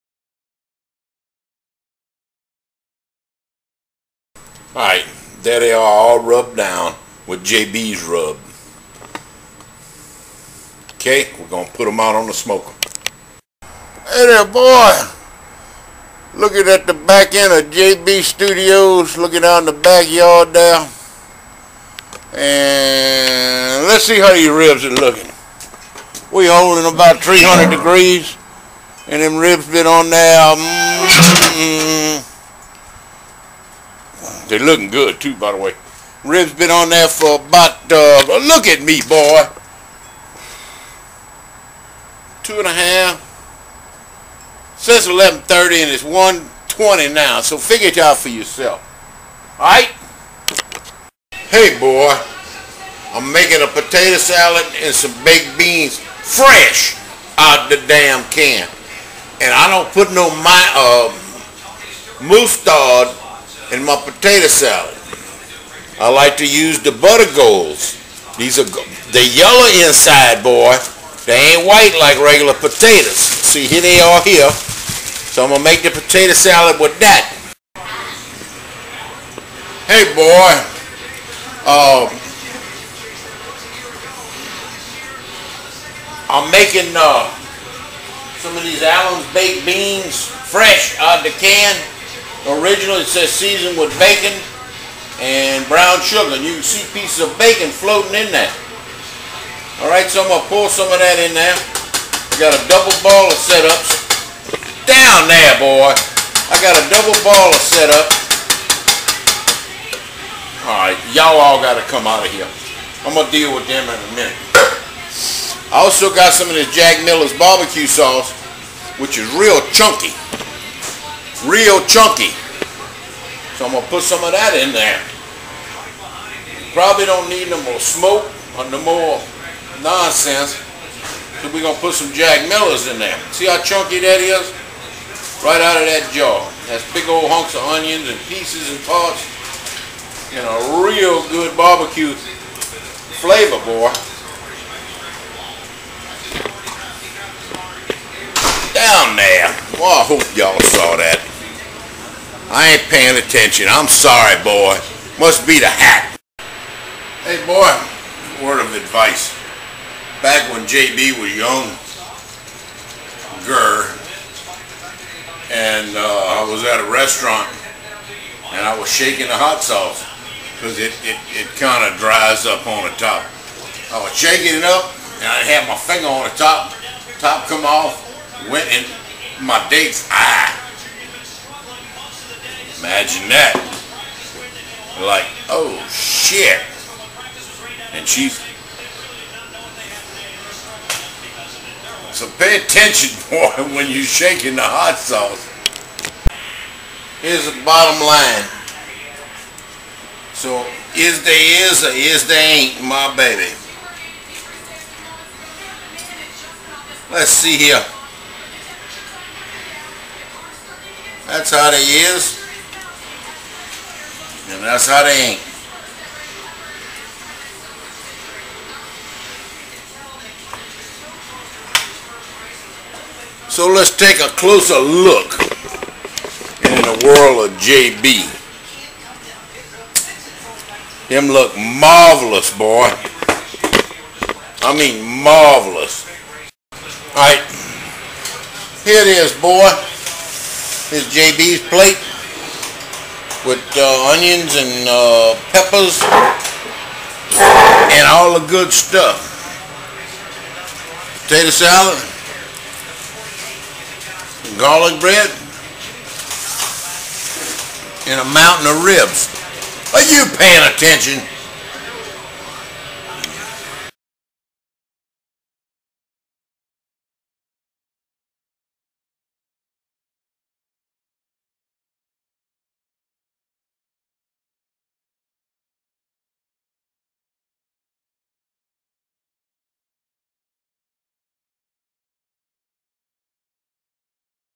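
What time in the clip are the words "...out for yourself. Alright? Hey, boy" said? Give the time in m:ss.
0:47.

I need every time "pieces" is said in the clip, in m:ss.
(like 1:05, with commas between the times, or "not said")
1:36, 2:18.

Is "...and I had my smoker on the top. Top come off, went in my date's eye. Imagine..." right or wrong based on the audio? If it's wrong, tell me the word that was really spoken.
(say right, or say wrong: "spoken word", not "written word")
wrong: "finger", not "smoker".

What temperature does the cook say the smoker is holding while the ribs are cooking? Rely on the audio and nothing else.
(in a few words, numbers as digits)
300 degrees.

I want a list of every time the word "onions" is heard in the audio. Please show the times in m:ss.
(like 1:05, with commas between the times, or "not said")
2:17, 4:04.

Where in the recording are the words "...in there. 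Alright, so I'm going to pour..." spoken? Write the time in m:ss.
1:38.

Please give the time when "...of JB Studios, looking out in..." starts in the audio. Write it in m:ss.
0:17.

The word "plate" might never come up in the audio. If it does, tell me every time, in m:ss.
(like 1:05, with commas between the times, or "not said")
4:01.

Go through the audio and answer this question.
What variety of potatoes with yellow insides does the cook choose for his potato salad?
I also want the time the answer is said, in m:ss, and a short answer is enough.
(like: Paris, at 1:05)
Butter golds, at 1:06.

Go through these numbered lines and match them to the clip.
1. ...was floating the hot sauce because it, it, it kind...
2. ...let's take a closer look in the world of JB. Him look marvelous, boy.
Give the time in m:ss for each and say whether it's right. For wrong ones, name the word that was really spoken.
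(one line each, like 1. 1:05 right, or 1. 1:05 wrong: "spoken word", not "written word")
1. 2:48 wrong: "shaking", not "floating"
2. 3:43 right.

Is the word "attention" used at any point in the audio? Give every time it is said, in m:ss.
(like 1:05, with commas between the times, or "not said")
2:33, 3:12, 4:20.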